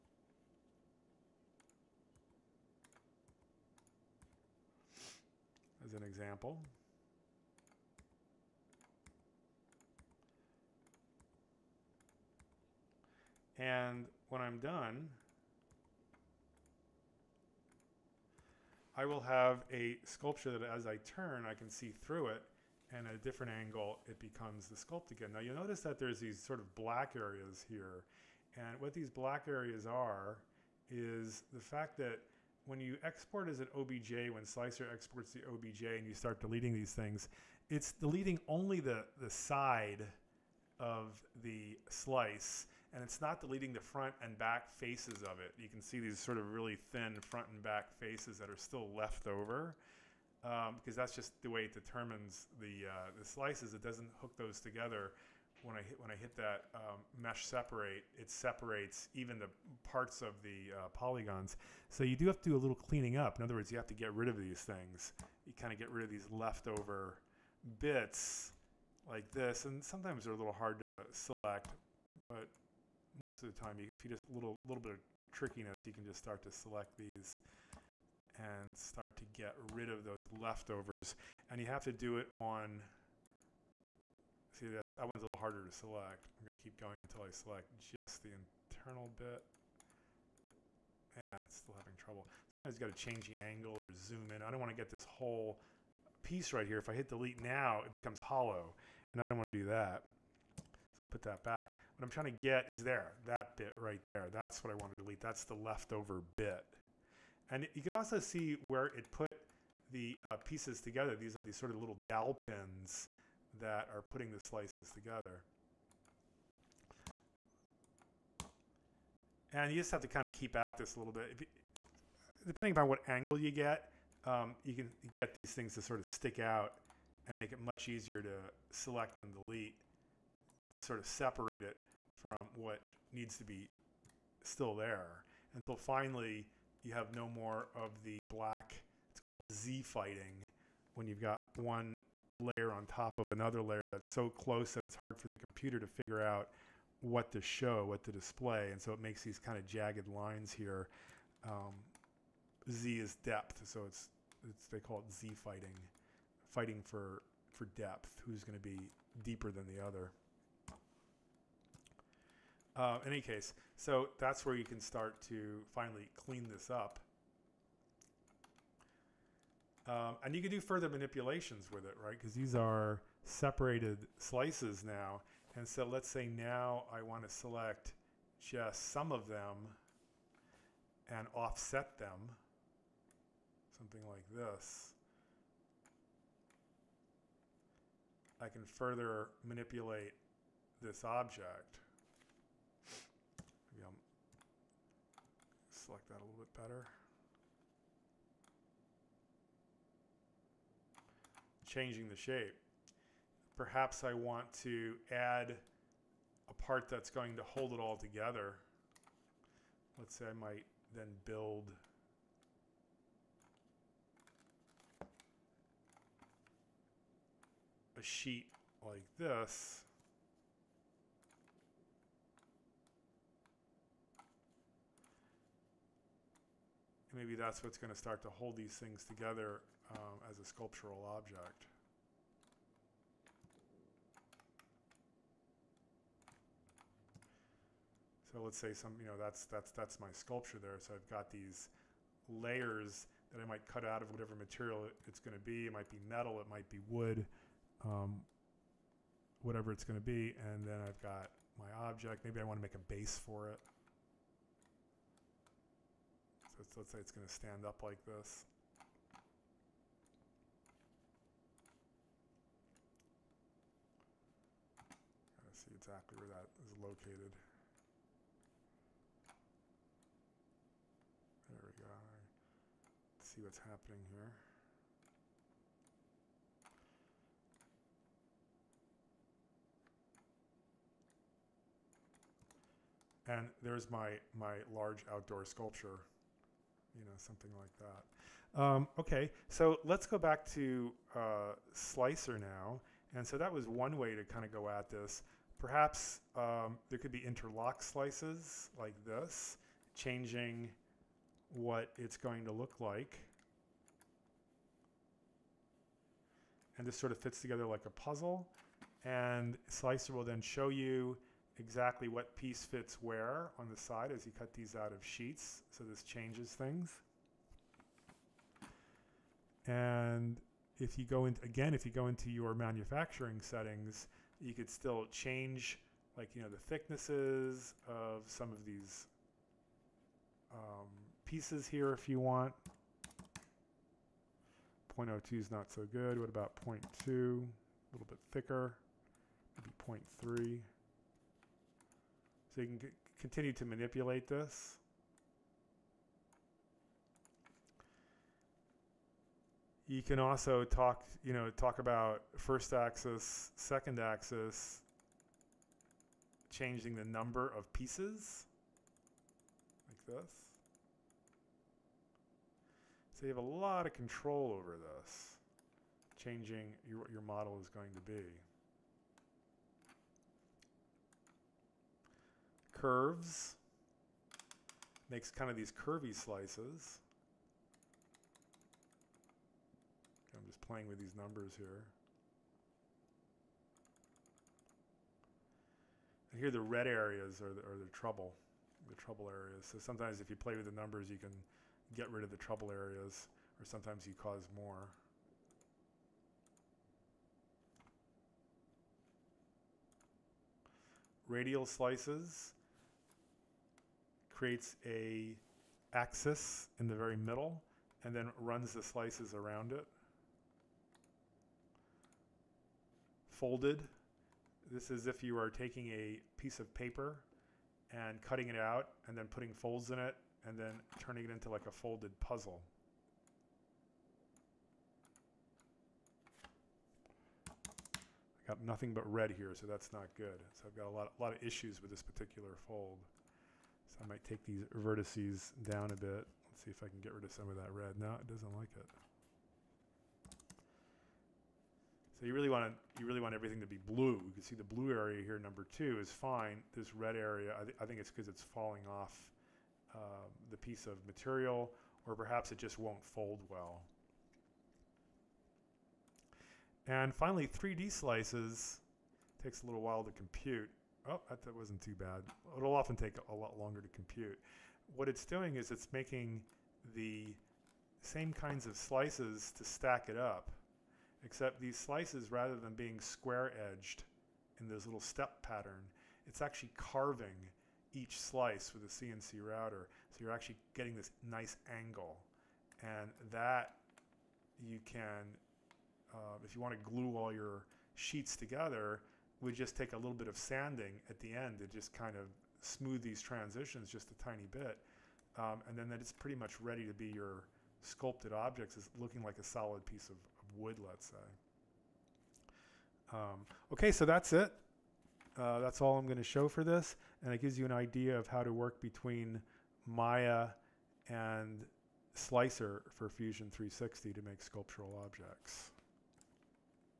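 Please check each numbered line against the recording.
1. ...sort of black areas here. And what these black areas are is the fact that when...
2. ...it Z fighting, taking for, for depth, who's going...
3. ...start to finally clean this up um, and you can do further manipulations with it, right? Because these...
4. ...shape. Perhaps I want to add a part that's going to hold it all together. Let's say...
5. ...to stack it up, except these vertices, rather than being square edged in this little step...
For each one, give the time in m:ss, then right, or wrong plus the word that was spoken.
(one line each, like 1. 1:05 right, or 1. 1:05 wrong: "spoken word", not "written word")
1. 0:26 right
2. 2:35 wrong: "fighting", not "taking"
3. 2:44 right
4. 3:22 right
5. 7:49 wrong: "slices", not "vertices".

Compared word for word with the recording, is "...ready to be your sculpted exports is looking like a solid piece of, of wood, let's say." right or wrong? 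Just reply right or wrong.
wrong.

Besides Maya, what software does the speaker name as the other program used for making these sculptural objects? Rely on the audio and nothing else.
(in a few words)
Fusion 360.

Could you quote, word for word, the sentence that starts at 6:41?
Radial slices creates a axis in the very middle and then runs the slices around it.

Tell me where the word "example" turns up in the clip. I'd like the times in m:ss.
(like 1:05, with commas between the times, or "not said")
0:06.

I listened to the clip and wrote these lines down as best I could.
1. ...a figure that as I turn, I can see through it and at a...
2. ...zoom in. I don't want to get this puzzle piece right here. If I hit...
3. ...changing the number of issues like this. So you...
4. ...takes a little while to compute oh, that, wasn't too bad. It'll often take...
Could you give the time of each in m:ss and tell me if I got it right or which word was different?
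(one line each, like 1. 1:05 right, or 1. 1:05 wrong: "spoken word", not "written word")
1. 0:19 wrong: "sculpture", not "figure"
2. 1:34 wrong: "whole", not "puzzle"
3. 5:56 wrong: "pieces", not "issues"
4. 7:39 right.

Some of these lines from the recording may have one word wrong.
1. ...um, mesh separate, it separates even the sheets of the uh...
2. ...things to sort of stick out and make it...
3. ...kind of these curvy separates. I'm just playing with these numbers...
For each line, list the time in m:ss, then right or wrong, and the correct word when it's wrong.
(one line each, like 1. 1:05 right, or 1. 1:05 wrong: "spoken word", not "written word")
1. 0:56 wrong: "parts", not "sheets"
2. 2:05 right
3. 6:15 wrong: "slices", not "separates".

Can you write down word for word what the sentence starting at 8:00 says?
So you're actually getting this nice angle.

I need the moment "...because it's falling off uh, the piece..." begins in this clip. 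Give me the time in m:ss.
7:28.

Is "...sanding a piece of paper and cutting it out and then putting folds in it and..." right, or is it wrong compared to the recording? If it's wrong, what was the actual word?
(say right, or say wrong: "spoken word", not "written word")
wrong: "taking", not "sanding".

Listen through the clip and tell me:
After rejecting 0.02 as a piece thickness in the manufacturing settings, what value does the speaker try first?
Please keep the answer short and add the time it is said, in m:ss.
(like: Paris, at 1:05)
0.2, at 5:36.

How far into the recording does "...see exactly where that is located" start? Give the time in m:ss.
4:25.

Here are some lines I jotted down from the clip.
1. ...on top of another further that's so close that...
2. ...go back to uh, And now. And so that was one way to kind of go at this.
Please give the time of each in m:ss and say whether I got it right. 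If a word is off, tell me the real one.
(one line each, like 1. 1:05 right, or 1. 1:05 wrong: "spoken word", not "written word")
1. 2:22 wrong: "layer", not "further"
2. 4:50 wrong: "Slicer", not "And".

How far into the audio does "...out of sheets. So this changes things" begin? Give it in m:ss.
5:14.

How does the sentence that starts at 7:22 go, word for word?
So you really want to, you really want everything to be blue.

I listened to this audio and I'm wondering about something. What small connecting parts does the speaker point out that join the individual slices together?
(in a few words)
dowel pins.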